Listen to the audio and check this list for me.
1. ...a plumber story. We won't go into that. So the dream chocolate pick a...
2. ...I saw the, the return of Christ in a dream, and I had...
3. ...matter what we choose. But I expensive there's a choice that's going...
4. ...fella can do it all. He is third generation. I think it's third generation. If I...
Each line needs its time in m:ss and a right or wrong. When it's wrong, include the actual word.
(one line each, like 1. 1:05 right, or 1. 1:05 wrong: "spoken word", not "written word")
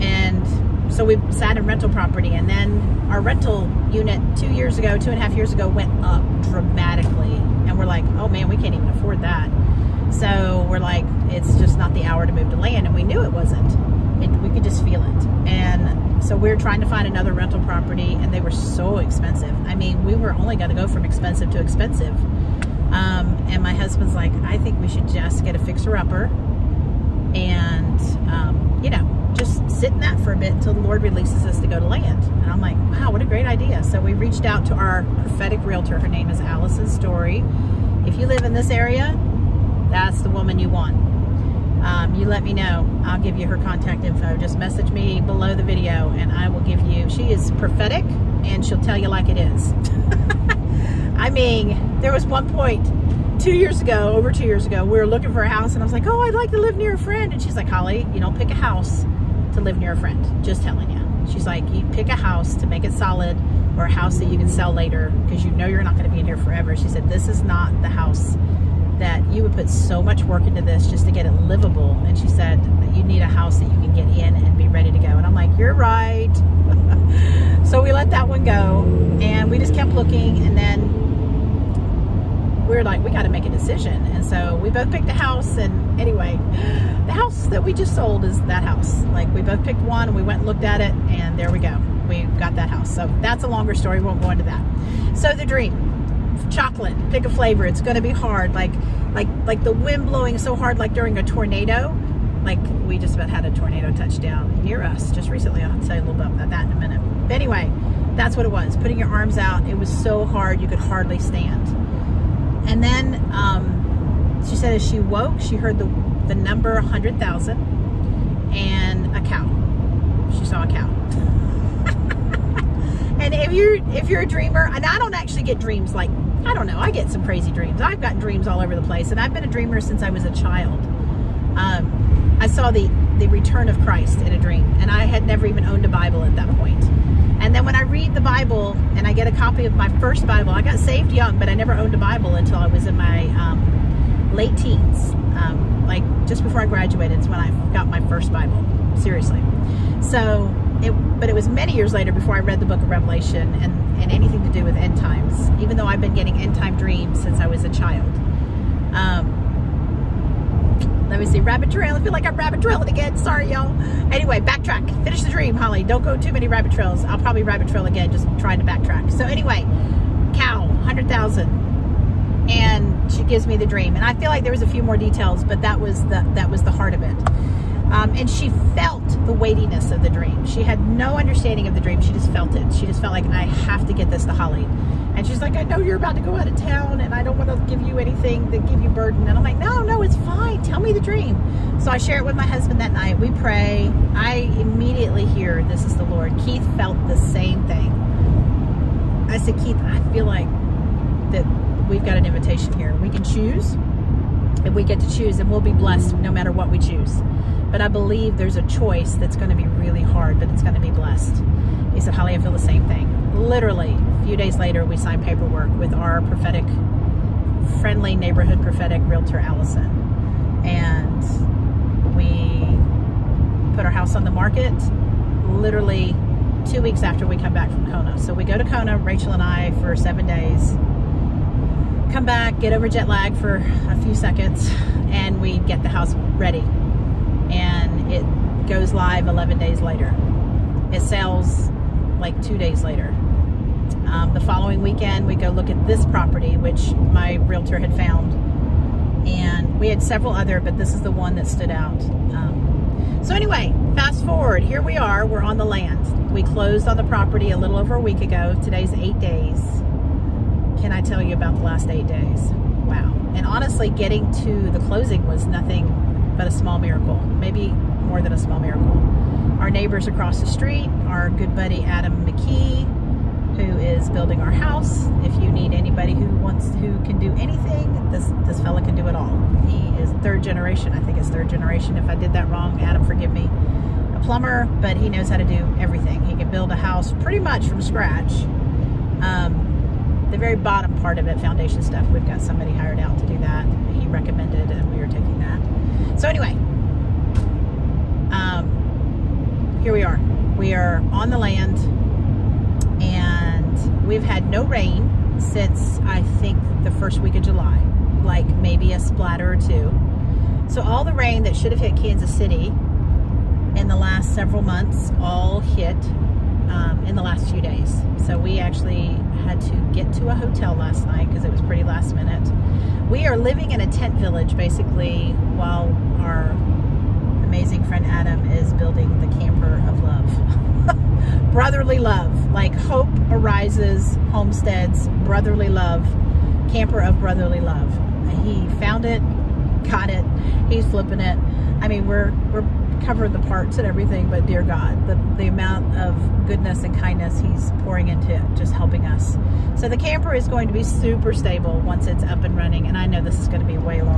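1. 1:33 wrong: "longer", not "plumber"
2. 2:12 right
3. 3:26 wrong: "believe", not "expensive"
4. 4:38 right.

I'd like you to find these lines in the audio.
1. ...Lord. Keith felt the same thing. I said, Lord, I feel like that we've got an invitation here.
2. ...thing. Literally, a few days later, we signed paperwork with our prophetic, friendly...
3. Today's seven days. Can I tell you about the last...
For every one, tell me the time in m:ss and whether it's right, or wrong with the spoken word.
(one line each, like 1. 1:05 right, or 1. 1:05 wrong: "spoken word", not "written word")
1. 3:16 wrong: "Keith", not "Lord"
2. 3:32 right
3. 4:18 wrong: "eight", not "seven".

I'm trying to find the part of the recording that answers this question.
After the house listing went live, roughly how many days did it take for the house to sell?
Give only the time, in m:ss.
4:02.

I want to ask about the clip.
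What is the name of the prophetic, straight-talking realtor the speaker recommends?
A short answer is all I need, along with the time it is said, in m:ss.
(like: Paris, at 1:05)
Allison Story, at 0:36.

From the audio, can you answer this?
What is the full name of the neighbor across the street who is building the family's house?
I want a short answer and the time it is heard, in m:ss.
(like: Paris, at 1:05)
Adam McKee, at 4:31.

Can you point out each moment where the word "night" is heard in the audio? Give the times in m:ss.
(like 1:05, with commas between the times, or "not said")
3:12, 5:21.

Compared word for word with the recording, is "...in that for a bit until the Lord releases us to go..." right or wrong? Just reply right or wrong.
right.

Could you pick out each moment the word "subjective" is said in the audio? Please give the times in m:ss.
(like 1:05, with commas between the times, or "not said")
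not said.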